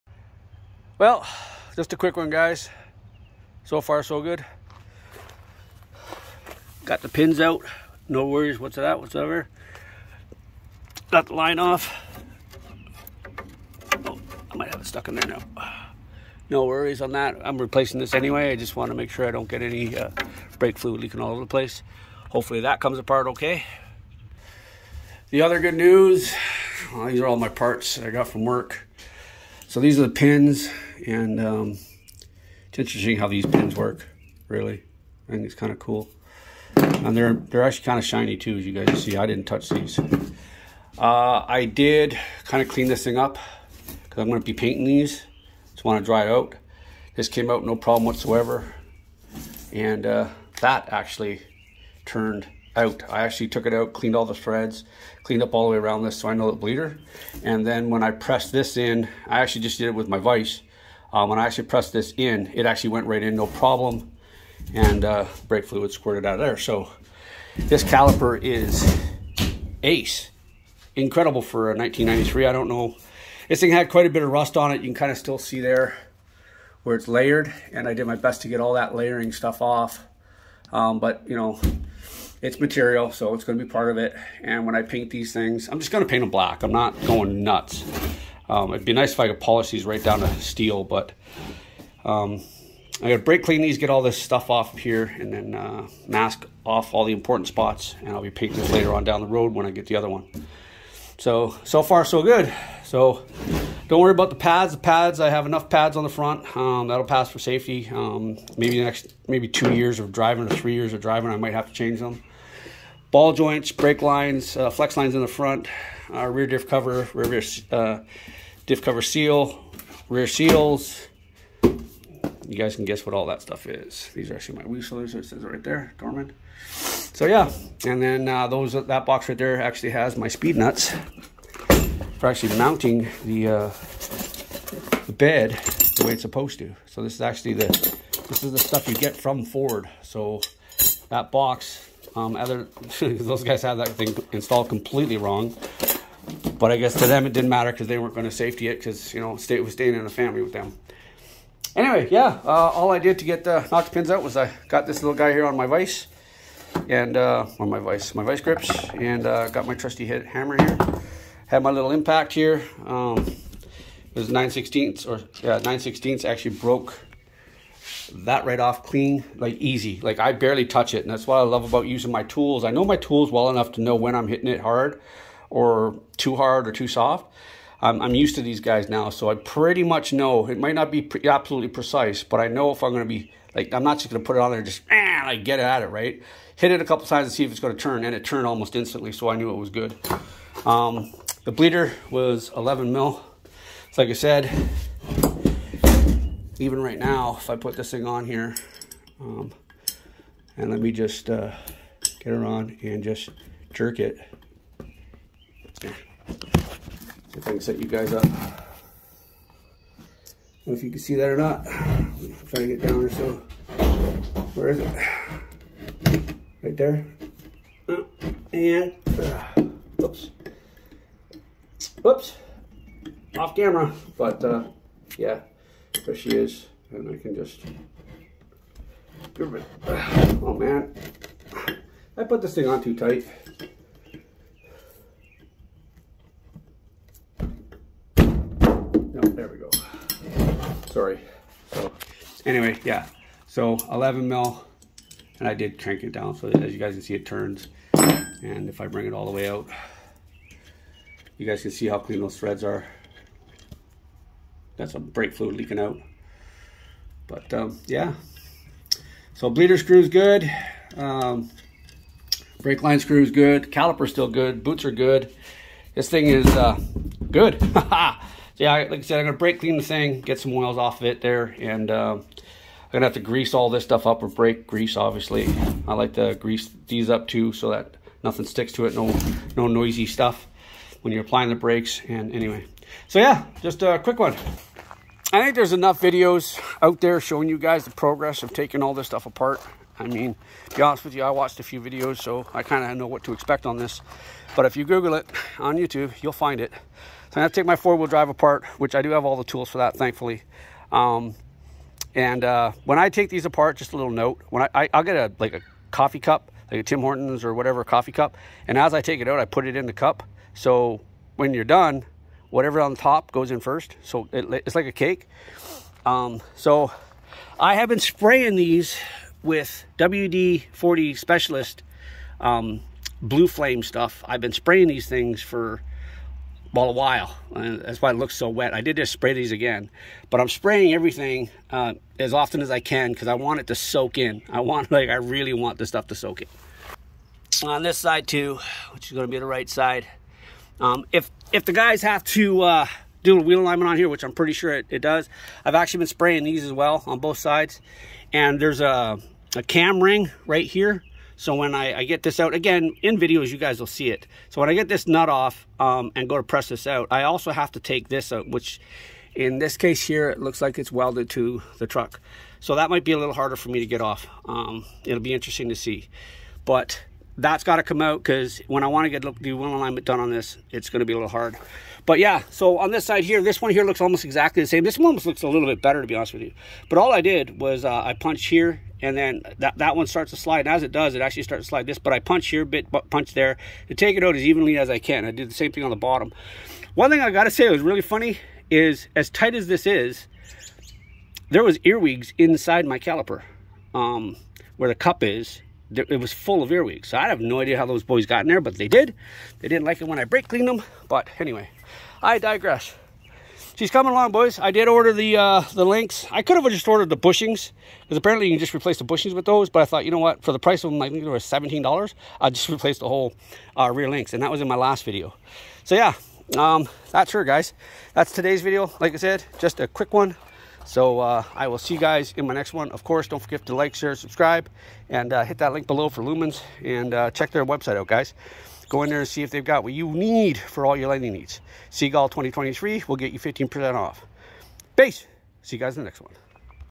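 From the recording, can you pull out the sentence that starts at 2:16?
So this is actually the this is the stuff you get from Ford.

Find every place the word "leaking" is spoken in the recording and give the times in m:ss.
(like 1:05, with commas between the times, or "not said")
0:21, 4:15.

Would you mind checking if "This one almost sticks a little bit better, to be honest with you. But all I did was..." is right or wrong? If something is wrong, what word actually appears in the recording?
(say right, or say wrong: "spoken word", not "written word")
wrong: "looks", not "sticks".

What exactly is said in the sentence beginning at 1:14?
You can kind of still see there where it's layered.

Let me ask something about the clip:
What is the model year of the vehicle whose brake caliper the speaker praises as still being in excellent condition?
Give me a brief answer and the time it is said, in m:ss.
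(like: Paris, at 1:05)
1993, at 1:11.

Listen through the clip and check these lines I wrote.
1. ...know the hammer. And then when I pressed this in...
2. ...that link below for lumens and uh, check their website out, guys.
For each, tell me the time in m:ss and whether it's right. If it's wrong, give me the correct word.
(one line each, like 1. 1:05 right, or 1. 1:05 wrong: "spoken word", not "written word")
1. 0:56 wrong: "bleeder", not "hammer"
2. 7:05 right.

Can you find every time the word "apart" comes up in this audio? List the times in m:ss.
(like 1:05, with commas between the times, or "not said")
0:22, 4:49, 4:58, 5:03.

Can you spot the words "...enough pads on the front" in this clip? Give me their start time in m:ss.
1:45.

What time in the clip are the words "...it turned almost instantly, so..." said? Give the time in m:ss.
3:08.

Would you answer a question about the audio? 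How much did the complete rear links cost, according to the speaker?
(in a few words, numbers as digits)
$17.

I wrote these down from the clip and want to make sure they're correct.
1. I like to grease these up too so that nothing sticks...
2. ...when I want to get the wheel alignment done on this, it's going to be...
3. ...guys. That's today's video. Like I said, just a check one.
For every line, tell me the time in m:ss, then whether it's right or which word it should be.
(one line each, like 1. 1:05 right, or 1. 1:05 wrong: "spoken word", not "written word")
1. 4:35 right
2. 6:08 right
3. 6:57 wrong: "quick", not "check".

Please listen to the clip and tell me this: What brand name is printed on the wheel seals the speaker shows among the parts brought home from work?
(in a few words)
Dorman.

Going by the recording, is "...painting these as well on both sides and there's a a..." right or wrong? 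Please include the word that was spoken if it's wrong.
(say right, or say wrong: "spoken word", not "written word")
wrong: "spraying", not "painting".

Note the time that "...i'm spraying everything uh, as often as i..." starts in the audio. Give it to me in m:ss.
5:30.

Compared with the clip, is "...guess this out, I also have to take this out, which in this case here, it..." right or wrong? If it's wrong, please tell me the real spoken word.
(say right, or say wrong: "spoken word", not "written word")
wrong: "press", not "guess".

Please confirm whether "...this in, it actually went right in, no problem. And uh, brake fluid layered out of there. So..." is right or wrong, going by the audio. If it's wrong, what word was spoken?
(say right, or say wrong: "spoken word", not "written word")
wrong: "squirted", not "layered".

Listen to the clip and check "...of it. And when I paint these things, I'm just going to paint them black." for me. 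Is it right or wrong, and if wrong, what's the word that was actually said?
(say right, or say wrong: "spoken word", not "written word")
right.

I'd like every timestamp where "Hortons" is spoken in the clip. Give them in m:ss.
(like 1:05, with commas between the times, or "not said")
5:07.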